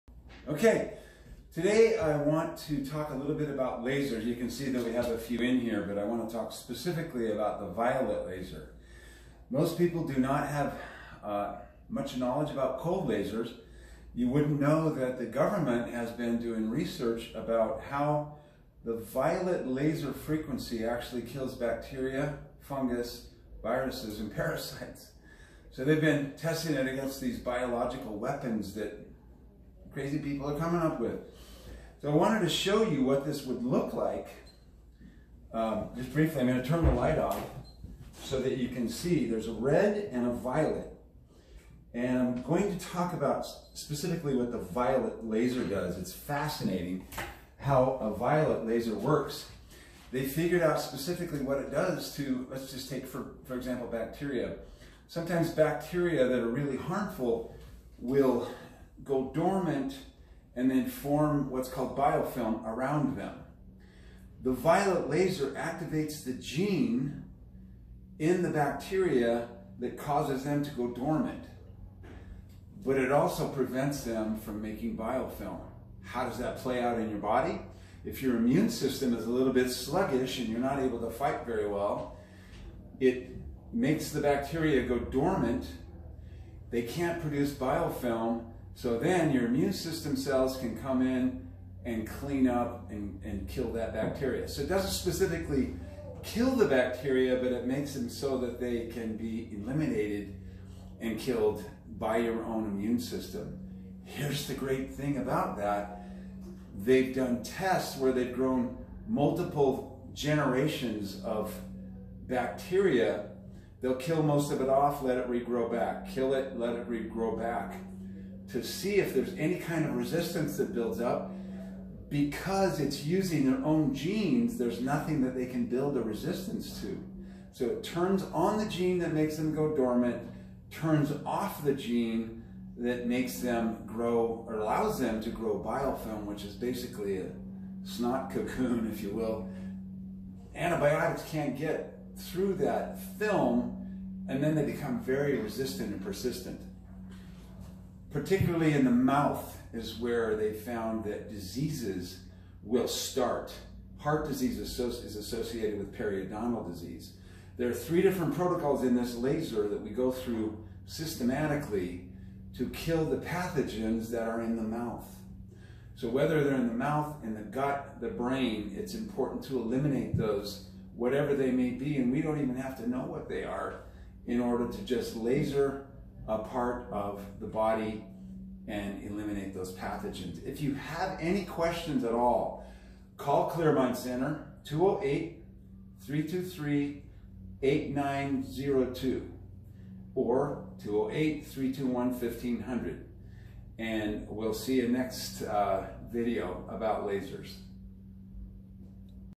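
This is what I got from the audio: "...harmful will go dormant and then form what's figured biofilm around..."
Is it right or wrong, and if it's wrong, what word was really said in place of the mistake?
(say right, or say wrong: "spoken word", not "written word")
wrong: "called", not "figured".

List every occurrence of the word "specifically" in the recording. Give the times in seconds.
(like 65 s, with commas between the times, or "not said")
6 s, 43 s, 50 s, 94 s.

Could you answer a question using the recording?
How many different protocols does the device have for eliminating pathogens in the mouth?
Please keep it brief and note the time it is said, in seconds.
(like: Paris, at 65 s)
3, at 157 s.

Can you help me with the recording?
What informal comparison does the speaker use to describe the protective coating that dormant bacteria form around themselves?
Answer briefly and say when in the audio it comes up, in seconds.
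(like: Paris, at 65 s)
Snot cocoon, at 137 s.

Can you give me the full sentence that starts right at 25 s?
So they've been testing it against these biological weapons that crazy people are coming up with.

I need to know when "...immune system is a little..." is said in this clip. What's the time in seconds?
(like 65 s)
78 s.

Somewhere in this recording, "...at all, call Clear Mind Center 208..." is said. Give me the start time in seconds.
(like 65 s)
182 s.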